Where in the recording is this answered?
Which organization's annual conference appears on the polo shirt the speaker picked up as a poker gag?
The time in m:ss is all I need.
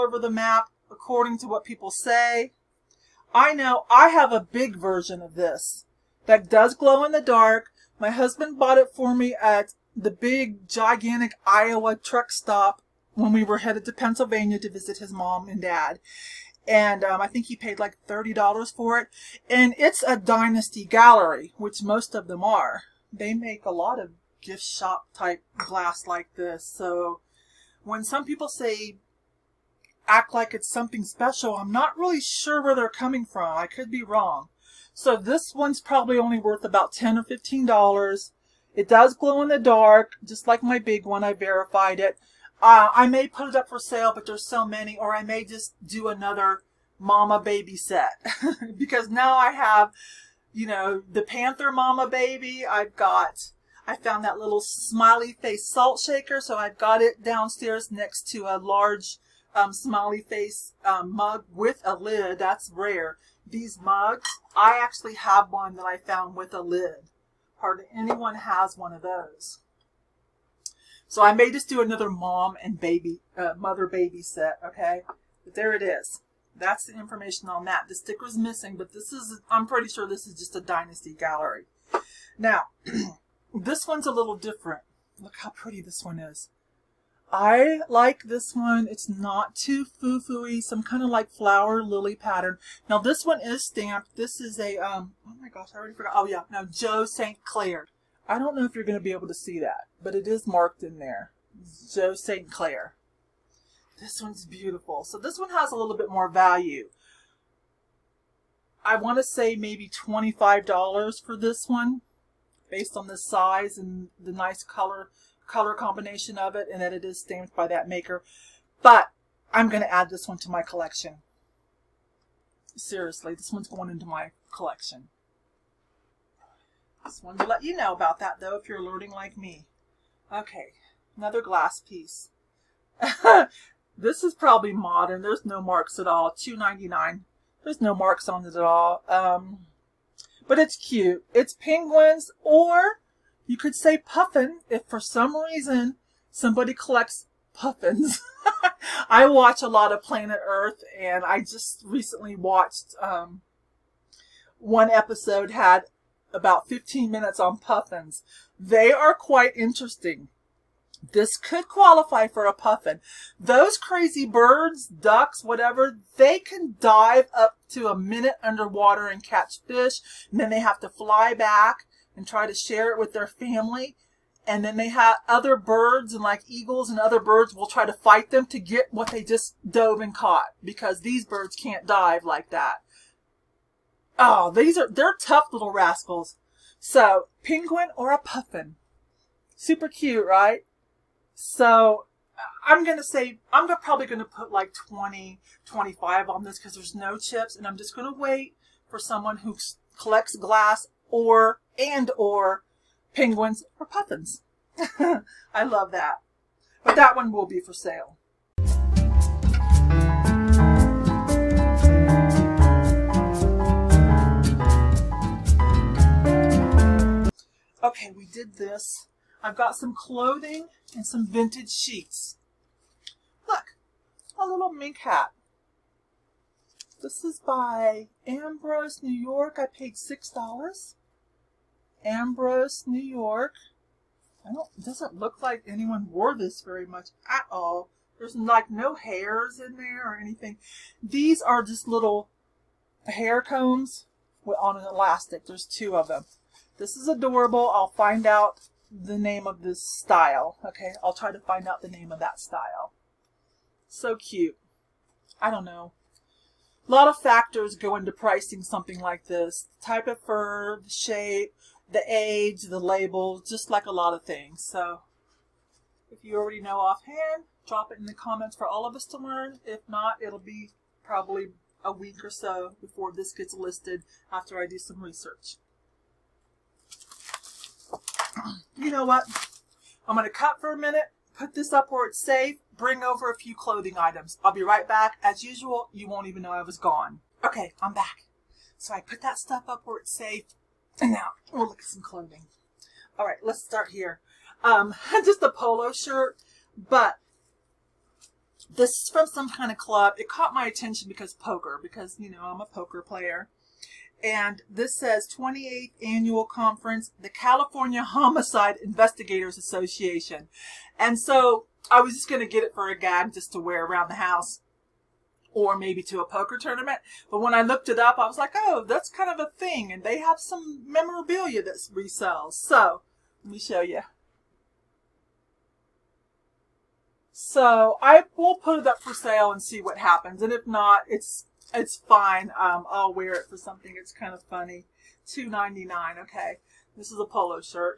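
5:07.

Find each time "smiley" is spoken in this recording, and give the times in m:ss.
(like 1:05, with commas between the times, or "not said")
0:54, 0:59.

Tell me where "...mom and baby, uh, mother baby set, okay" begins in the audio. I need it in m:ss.
1:12.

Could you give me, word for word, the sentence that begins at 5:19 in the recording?
And they have some memorabilia that resells.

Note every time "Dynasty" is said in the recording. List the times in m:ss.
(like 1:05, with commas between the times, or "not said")
0:20, 1:20.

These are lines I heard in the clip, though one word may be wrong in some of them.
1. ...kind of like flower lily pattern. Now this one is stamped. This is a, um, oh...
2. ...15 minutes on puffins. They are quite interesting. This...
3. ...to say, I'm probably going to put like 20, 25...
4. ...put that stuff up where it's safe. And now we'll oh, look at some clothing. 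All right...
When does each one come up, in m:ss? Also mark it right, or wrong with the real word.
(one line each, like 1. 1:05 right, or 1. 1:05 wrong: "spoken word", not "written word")
1. 1:30 right
2. 2:36 right
3. 3:12 right
4. 4:49 right.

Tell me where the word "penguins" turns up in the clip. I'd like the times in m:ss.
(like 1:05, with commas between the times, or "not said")
2:21, 3:07, 3:23.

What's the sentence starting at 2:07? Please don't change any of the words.
Just wanted to let you know about that though if you're learning like me.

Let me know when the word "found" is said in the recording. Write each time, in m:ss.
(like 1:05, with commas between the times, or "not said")
0:53, 1:05.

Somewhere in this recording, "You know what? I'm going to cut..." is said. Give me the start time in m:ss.
4:38.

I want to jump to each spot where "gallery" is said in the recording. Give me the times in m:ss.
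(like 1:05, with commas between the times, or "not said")
0:20, 1:21.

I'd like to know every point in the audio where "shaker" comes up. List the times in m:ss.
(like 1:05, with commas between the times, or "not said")
0:55.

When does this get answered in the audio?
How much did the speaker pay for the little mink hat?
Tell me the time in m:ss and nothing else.
3:49.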